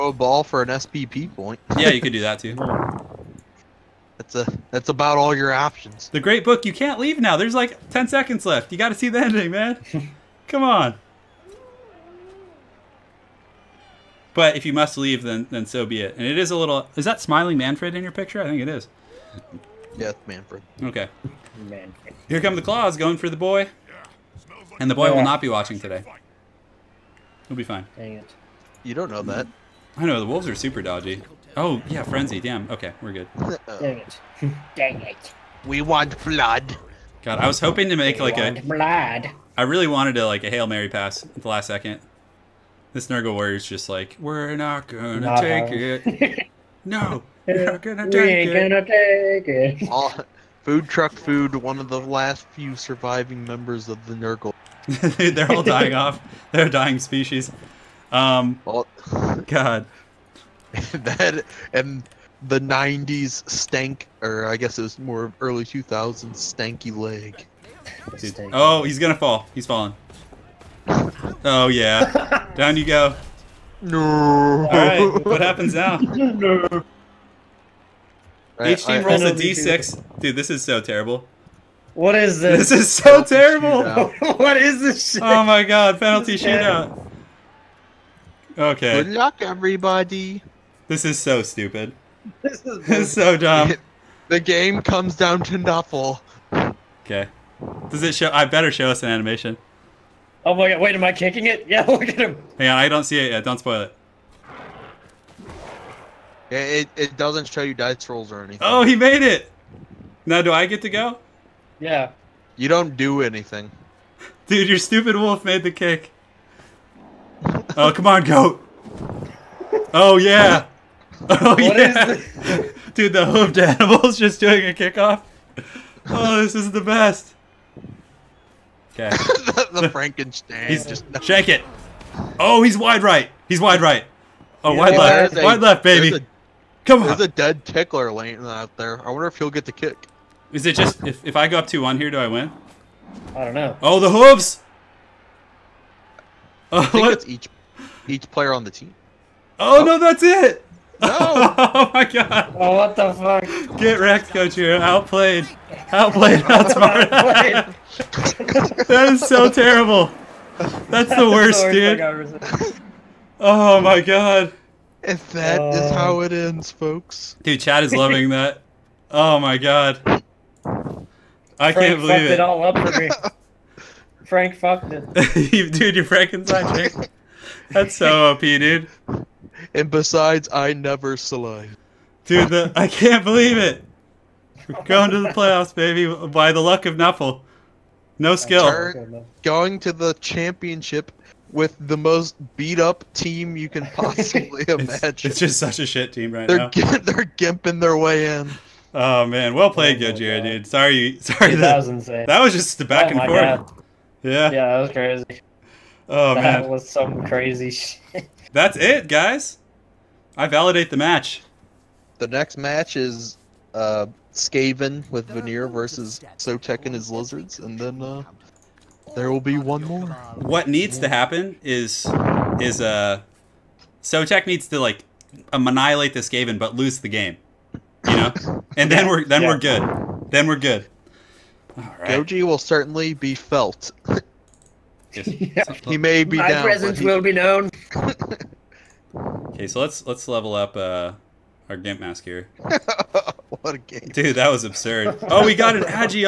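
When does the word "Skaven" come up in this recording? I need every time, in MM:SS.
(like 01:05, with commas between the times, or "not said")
03:34, 03:46.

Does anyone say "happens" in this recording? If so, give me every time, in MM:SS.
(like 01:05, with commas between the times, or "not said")
01:15, 03:41.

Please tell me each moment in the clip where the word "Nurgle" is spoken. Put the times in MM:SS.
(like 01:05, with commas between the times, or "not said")
00:43, 00:54.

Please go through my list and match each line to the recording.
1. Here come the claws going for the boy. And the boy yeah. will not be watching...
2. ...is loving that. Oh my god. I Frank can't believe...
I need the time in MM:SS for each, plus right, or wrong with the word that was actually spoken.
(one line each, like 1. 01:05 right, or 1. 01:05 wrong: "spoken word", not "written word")
1. 00:22 right
2. 02:47 right.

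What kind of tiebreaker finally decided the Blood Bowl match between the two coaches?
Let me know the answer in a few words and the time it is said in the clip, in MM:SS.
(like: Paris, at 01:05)
Penalty shootout, at 01:25.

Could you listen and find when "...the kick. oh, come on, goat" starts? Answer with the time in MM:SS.
01:55.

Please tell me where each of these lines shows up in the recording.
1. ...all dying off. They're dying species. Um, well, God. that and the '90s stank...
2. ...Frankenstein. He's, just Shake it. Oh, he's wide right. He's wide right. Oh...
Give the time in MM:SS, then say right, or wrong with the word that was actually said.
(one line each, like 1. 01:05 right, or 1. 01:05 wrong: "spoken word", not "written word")
1. 00:55 right
2. 02:09 right.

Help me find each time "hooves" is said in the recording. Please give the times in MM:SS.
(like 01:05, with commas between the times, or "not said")
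02:24.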